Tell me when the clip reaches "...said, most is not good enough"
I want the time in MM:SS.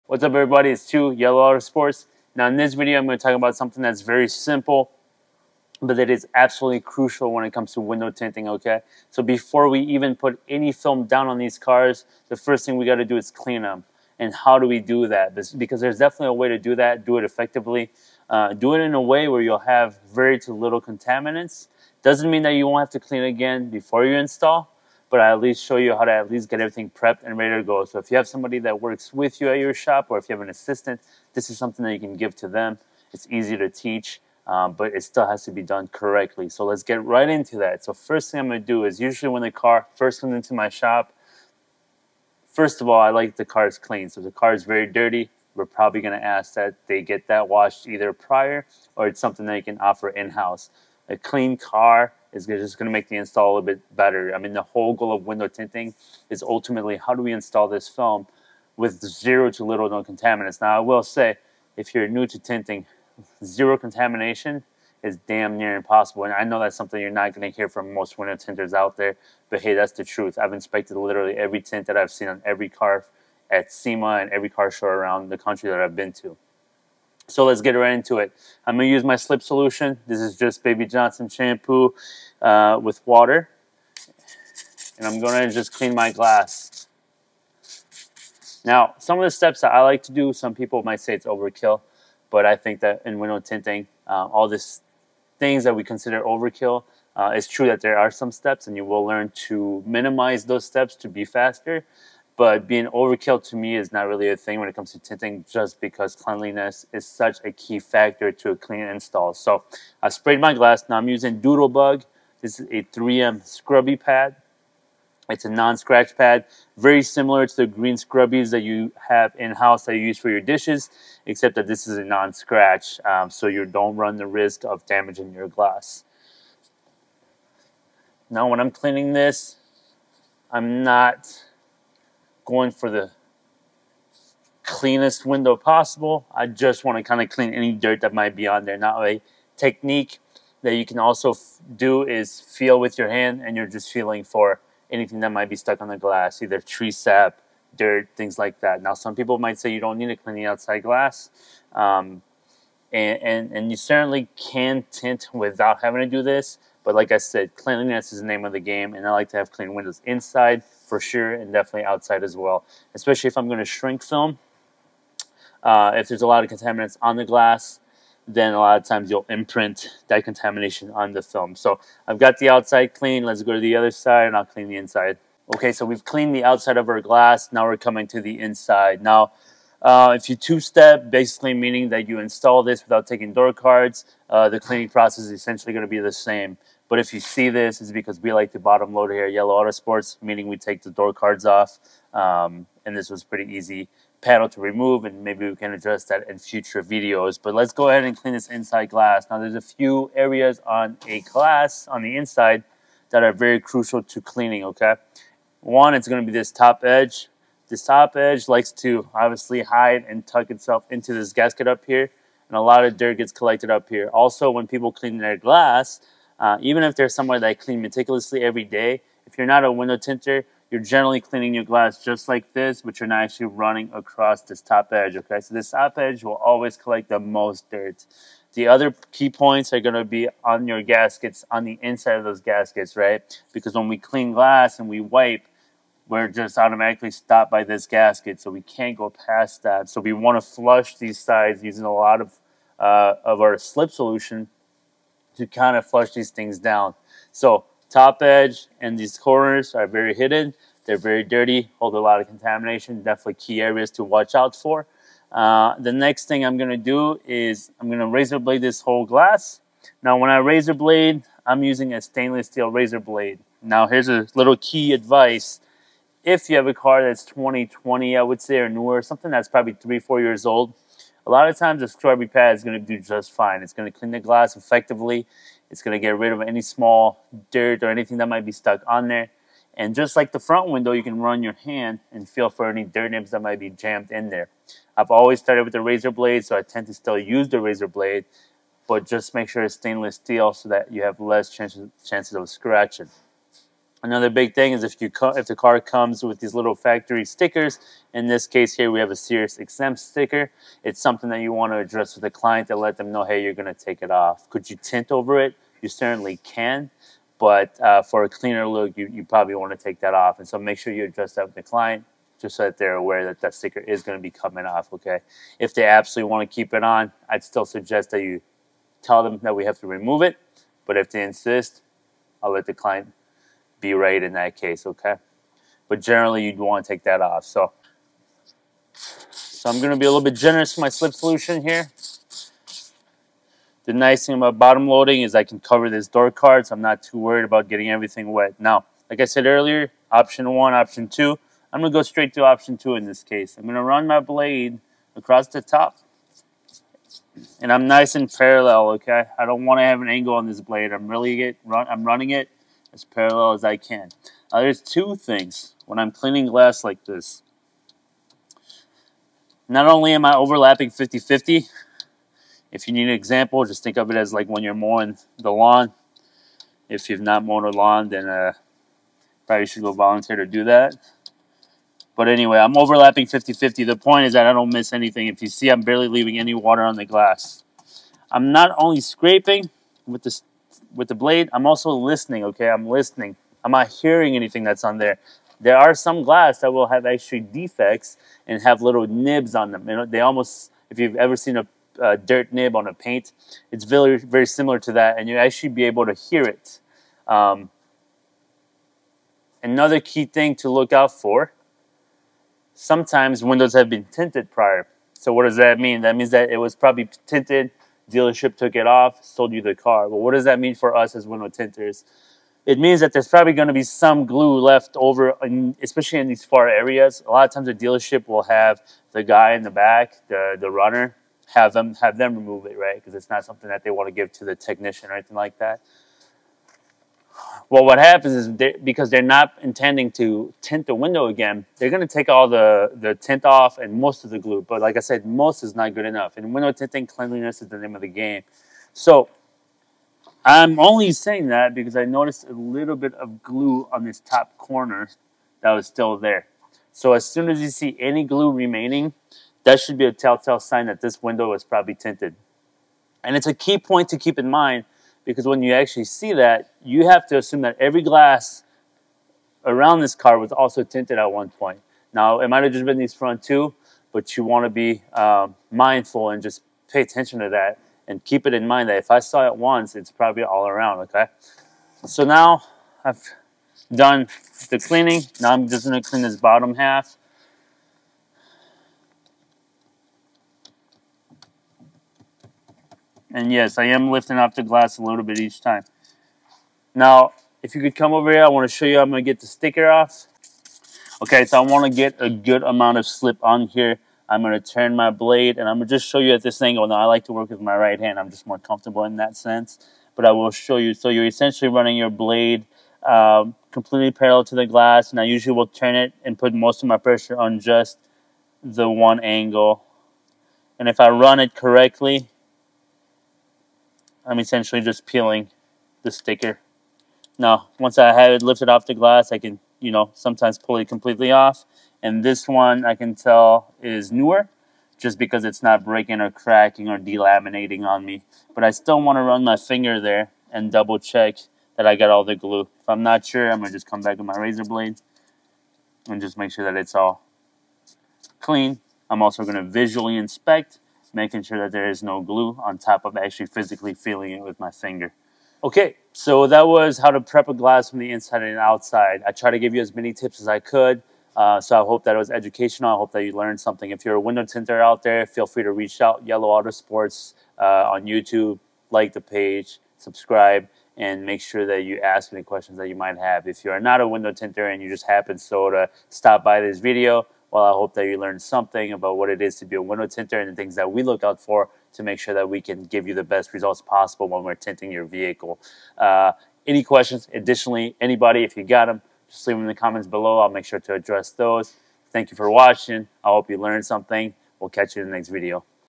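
07:14.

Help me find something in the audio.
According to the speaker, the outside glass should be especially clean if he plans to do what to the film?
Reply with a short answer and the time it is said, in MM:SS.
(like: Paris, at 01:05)
Shrink film, at 02:43.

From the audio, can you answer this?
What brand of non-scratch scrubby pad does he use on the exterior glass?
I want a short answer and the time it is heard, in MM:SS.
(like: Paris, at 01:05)
3M, at 01:52.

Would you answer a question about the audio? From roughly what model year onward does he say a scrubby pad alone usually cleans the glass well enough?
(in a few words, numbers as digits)
2020.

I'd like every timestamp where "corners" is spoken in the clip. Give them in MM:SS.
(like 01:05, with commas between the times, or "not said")
04:09, 07:24.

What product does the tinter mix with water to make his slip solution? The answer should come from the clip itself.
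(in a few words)
Baby Johnson shampoo.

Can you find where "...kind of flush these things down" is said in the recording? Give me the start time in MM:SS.
04:05.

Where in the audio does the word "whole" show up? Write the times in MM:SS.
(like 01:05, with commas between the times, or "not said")
00:54, 04:18.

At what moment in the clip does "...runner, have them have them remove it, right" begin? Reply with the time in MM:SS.
07:00.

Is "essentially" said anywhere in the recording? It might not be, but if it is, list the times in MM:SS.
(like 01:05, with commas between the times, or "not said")
03:05, 08:21, 08:34.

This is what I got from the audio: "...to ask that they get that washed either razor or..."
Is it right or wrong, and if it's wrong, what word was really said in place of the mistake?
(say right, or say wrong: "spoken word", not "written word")
wrong: "prior", not "razor".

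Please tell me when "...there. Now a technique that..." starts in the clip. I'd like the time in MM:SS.
02:18.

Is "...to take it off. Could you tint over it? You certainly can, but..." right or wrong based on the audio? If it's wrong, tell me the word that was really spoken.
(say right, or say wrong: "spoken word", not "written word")
right.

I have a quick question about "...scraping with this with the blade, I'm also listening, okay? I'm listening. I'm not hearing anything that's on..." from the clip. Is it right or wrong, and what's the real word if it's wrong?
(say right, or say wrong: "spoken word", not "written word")
right.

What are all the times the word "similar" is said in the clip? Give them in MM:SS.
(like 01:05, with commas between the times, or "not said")
01:57, 06:34.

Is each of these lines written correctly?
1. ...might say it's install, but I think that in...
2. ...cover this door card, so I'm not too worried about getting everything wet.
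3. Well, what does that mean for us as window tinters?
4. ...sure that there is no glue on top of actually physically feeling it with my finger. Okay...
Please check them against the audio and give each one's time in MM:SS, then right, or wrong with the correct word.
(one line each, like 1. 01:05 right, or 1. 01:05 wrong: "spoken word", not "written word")
1. 01:30 wrong: "overkill", not "install"
2. 05:35 right
3. 06:50 right
4. 09:01 right.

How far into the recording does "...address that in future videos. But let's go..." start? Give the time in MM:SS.
03:15.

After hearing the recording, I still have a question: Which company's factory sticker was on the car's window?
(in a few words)
Sirius XM.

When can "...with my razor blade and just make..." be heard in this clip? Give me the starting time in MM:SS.
08:54.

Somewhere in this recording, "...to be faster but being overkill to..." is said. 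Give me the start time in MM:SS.
01:40.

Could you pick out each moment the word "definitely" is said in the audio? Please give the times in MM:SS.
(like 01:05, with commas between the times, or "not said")
00:15, 02:41, 04:13.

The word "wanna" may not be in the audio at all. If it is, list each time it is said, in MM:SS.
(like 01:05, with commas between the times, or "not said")
04:00.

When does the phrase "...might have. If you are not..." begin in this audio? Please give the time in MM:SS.
09:22.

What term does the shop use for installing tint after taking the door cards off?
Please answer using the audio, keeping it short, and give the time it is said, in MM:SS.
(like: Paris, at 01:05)
Bottom load, at 03:08.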